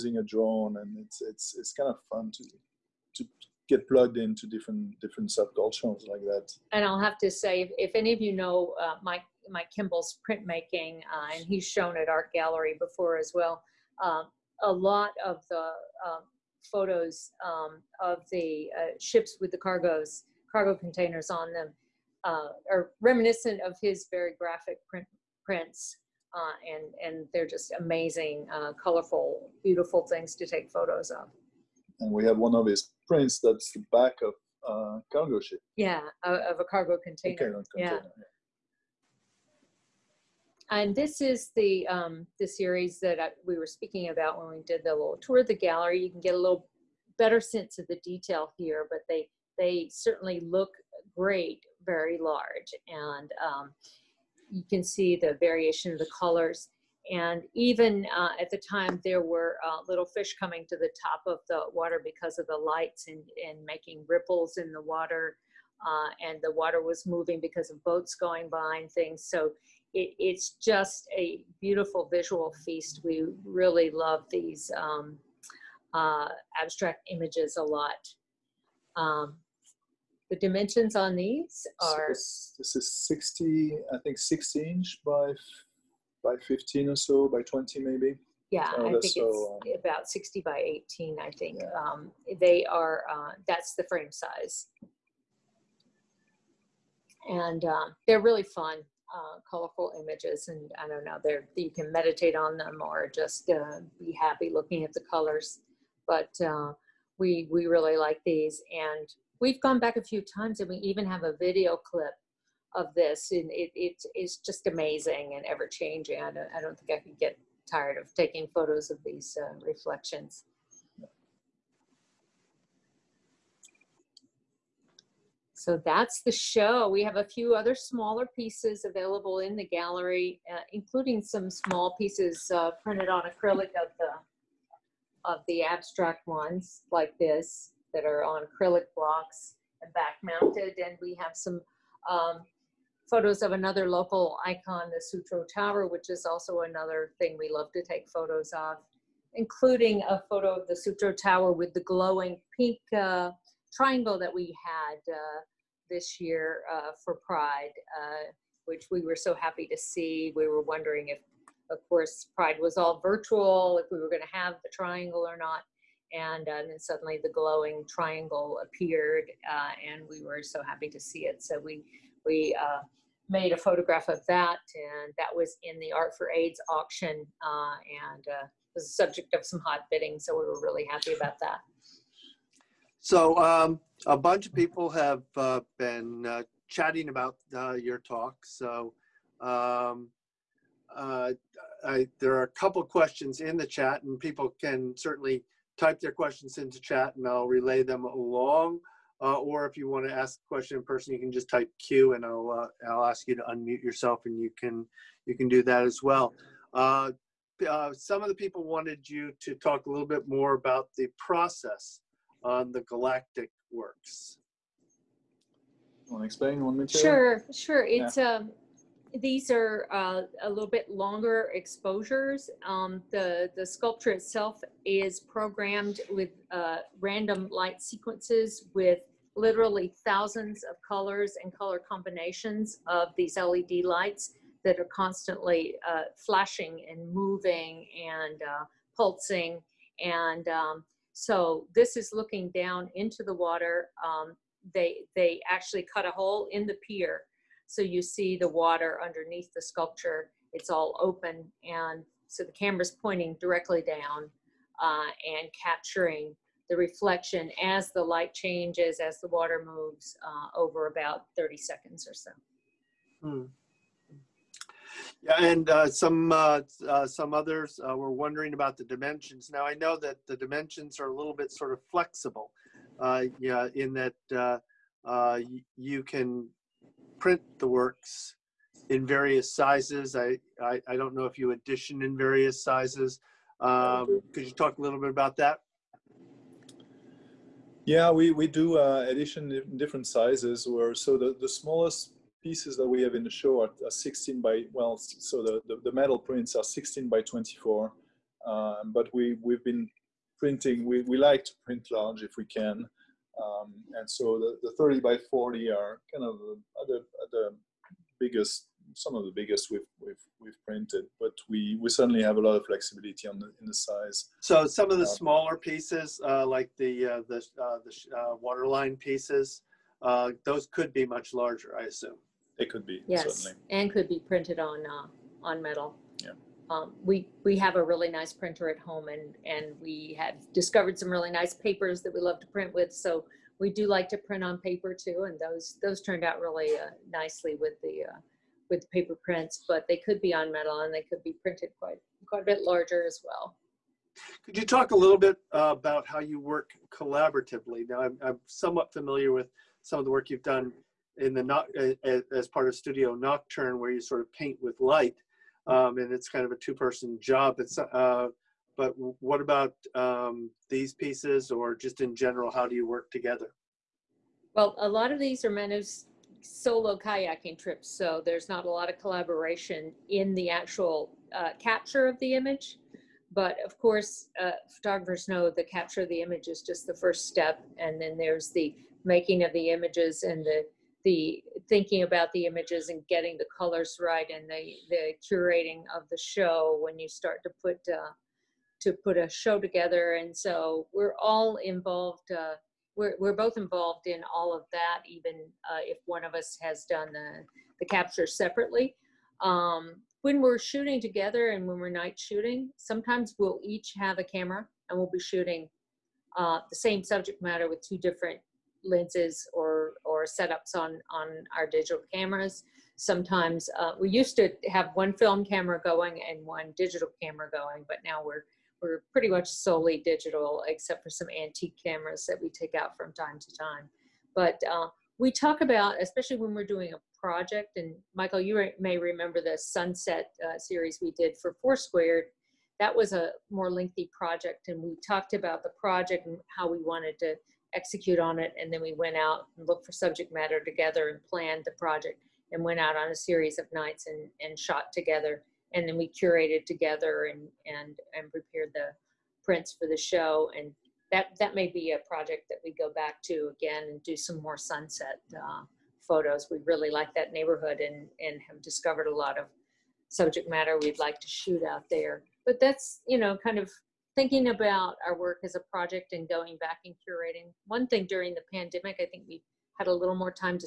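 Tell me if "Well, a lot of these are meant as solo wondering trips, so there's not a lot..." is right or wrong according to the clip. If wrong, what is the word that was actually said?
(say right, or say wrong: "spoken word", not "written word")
wrong: "kayaking", not "wondering".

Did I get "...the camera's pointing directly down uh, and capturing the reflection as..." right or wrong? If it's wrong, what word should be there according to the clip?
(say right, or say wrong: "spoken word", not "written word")
right.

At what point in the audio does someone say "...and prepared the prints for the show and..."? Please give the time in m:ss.
7:28.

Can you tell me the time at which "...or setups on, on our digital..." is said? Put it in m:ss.
6:50.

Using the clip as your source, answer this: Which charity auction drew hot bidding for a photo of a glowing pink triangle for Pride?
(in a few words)
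Art for AIDS.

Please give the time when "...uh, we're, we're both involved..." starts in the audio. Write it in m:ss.
6:32.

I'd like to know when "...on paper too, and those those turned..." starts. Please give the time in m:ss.
5:34.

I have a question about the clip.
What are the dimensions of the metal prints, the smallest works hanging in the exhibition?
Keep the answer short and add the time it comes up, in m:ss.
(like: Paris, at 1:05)
16 by 24, at 4:56.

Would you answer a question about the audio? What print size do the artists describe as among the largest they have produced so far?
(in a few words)
30 by 40.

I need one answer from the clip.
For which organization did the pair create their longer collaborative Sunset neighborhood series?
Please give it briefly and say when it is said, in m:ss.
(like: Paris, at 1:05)
Foursquare, at 7:11.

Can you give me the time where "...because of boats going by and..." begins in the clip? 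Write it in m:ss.
1:07.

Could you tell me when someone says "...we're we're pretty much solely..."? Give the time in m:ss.
6:58.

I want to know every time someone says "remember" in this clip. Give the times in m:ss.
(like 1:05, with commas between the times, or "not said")
7:08.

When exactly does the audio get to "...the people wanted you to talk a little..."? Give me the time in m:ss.
3:28.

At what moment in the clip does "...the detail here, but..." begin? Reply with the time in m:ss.
0:47.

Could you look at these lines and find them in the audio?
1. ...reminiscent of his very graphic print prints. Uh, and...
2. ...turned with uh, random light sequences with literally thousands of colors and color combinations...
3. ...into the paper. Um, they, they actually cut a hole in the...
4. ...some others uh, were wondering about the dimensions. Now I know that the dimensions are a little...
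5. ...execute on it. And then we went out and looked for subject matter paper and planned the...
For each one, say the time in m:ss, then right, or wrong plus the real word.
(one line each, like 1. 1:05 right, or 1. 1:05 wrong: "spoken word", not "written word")
1. 0:23 right
2. 3:45 wrong: "programmed", not "turned"
3. 4:02 wrong: "water", not "paper"
4. 4:27 right
5. 7:17 wrong: "together", not "paper".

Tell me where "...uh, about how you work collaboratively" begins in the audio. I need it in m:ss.
5:45.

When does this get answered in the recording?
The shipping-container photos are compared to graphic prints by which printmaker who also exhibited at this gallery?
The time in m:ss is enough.
0:09.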